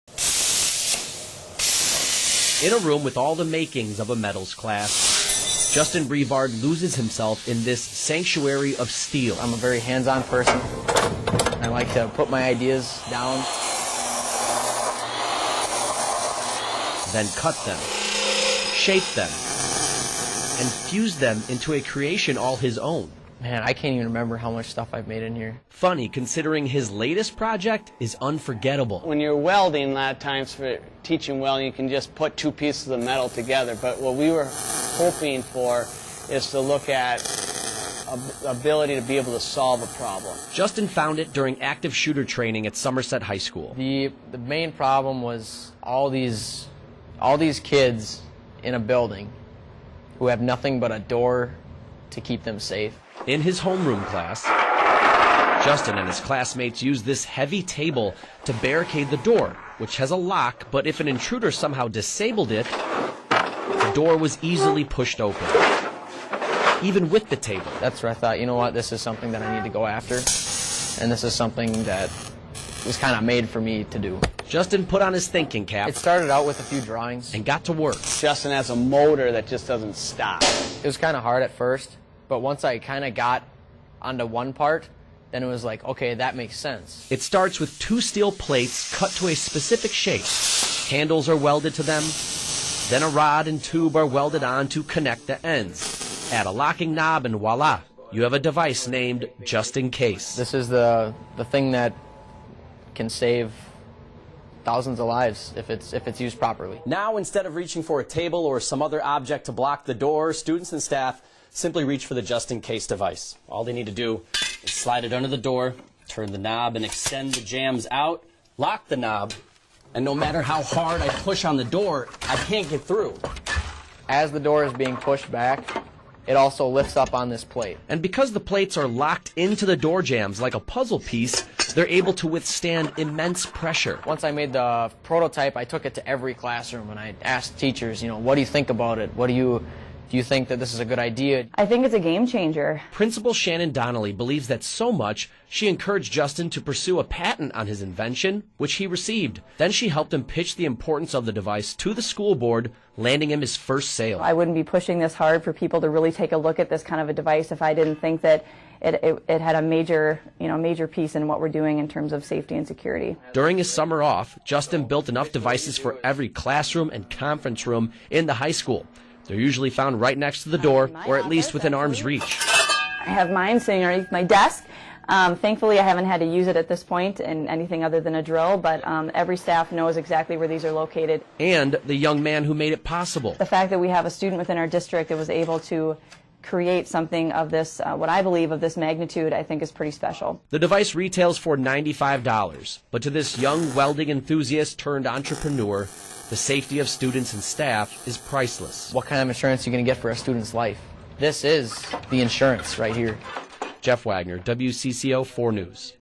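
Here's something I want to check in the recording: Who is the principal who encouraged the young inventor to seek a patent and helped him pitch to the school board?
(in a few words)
Shannon Donnelly.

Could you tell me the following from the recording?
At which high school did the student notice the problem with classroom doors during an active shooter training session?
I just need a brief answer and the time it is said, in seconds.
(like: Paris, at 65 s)
Somerset High School, at 42 s.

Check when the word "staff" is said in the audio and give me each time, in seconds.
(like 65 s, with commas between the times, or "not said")
110 s, 179 s, 197 s.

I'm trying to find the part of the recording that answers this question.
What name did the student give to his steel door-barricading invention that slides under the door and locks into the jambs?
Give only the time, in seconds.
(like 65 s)
99 s.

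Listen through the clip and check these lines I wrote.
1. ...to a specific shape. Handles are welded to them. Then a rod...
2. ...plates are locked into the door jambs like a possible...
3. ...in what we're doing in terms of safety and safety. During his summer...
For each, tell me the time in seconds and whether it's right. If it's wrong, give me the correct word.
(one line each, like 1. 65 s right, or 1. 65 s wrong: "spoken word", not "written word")
1. 89 s right
2. 128 s wrong: "puzzle", not "possible"
3. 161 s wrong: "security", not "safety".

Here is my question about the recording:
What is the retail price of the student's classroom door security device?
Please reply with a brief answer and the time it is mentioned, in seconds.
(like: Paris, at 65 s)
$95, at 191 s.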